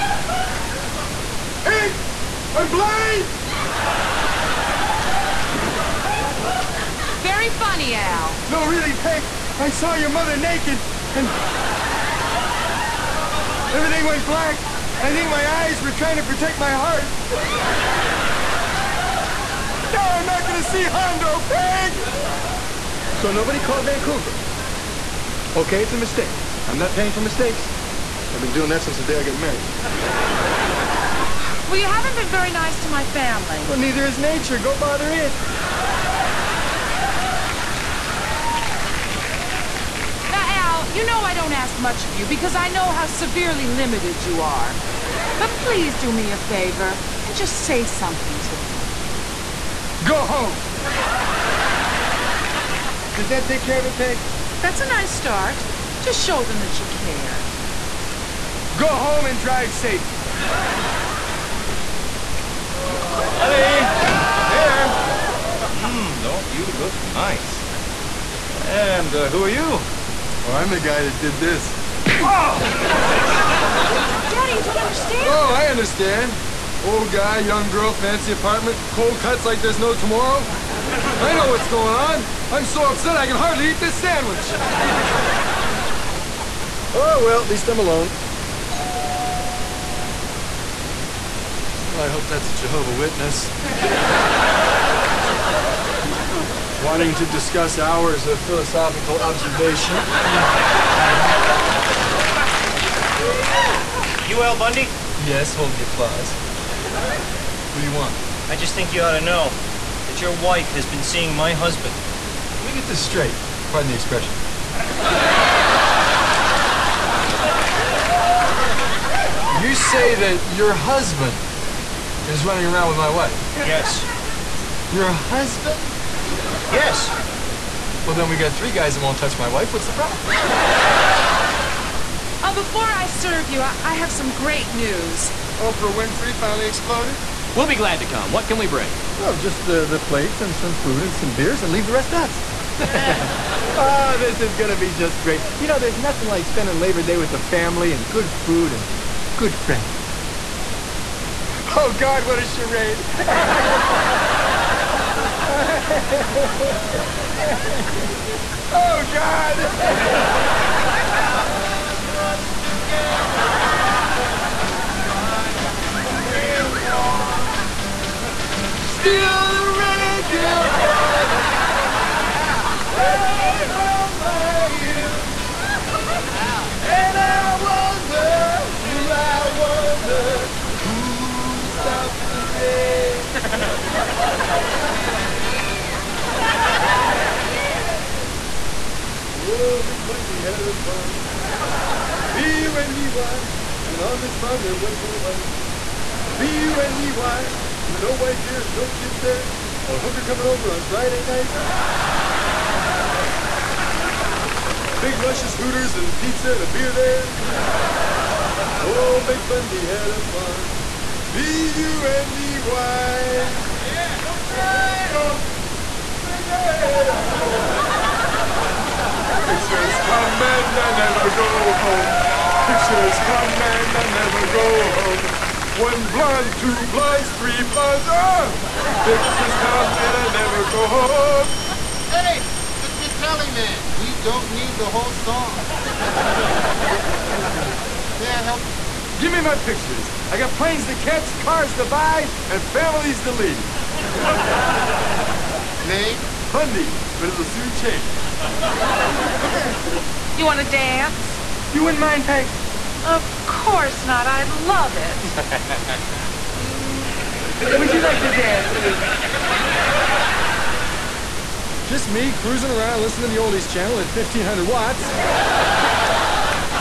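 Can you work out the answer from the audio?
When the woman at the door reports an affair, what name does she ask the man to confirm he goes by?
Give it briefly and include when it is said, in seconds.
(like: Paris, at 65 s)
Al Bundy, at 104 s.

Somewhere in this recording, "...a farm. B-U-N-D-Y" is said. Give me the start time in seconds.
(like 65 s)
210 s.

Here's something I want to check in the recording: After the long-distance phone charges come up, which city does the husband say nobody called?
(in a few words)
Vancouver.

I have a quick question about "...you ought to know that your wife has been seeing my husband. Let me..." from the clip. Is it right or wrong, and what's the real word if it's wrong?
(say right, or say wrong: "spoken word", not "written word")
right.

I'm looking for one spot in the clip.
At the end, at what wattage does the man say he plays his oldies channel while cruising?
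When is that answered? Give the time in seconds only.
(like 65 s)
264 s.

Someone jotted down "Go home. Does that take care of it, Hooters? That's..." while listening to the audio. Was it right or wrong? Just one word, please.
wrong.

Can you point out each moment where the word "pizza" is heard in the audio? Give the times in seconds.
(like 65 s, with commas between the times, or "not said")
206 s.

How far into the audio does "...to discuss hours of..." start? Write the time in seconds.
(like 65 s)
97 s.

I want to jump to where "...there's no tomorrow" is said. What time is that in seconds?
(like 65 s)
79 s.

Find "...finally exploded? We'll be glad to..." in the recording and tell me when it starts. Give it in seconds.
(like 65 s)
136 s.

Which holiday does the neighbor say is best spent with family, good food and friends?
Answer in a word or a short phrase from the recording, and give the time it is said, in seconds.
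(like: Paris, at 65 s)
Labor Day, at 146 s.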